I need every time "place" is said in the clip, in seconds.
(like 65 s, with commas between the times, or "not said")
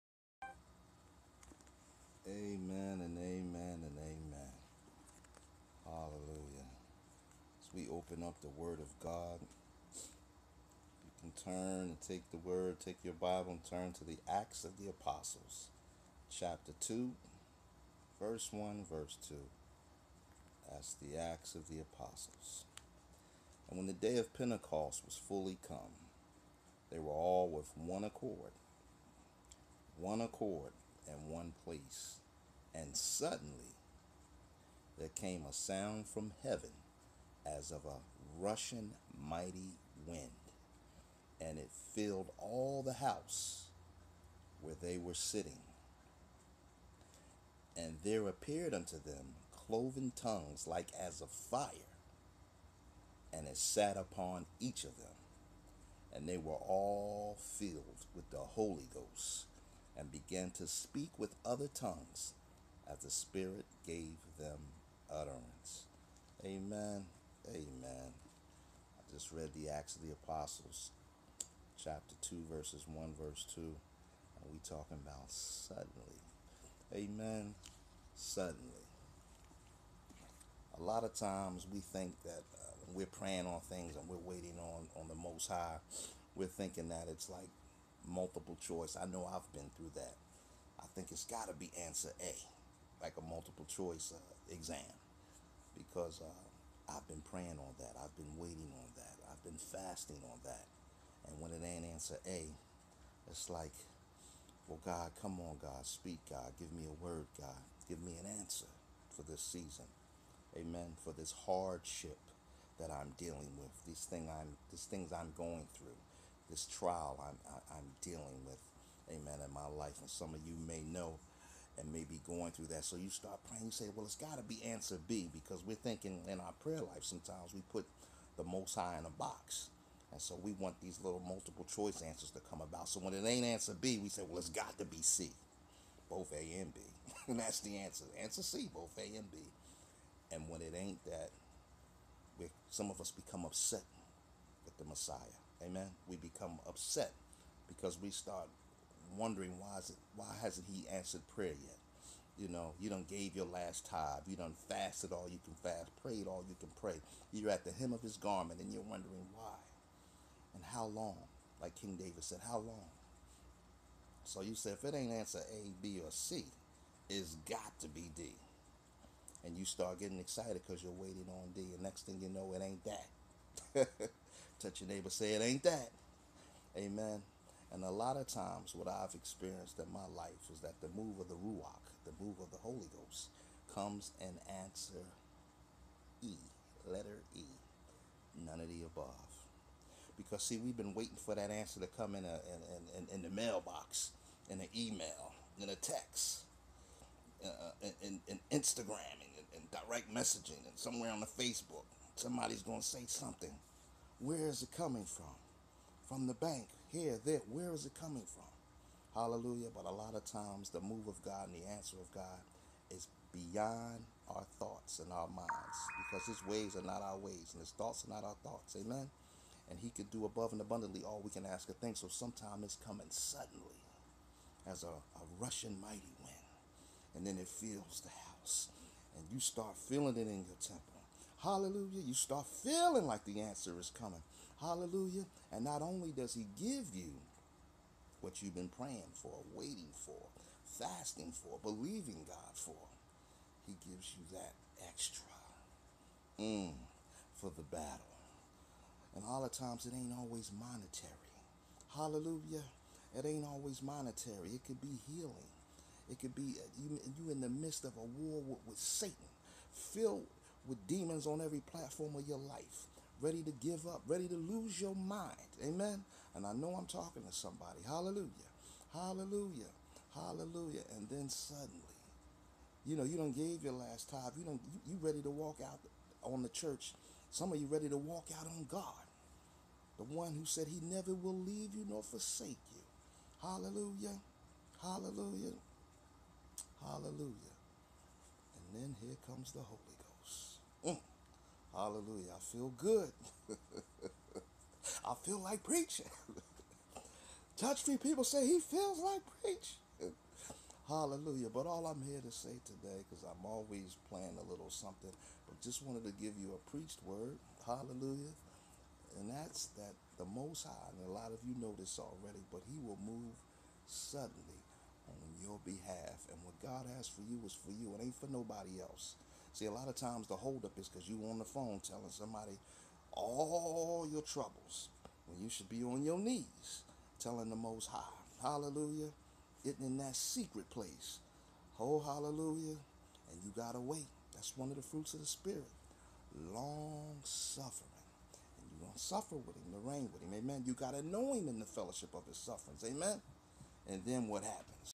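31 s, 330 s.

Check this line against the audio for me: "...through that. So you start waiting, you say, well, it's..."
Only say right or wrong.
wrong.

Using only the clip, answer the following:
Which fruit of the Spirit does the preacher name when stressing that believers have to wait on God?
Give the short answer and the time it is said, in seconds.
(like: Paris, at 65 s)
Long suffering, at 336 s.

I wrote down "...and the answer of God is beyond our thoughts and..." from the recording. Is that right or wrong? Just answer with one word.
right.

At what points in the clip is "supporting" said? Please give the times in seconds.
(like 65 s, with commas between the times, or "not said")
not said.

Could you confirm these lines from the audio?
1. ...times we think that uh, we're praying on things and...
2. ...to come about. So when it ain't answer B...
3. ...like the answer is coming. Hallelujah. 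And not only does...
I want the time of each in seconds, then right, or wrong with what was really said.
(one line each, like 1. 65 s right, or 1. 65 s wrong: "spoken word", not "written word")
1. 81 s right
2. 132 s right
3. 233 s right.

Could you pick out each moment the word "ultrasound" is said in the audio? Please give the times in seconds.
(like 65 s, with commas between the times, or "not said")
not said.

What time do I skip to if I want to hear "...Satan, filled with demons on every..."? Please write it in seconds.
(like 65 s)
258 s.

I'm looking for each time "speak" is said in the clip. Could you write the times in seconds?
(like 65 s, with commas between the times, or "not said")
60 s, 105 s.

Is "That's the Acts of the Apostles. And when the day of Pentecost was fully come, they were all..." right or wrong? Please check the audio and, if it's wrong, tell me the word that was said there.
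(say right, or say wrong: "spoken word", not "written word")
right.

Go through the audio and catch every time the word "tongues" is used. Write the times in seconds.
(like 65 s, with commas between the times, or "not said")
50 s, 61 s.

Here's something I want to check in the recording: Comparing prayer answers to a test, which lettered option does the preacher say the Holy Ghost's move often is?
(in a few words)
E, none of the above.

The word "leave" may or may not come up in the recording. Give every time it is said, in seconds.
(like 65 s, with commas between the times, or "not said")
281 s.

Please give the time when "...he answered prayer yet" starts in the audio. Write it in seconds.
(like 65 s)
150 s.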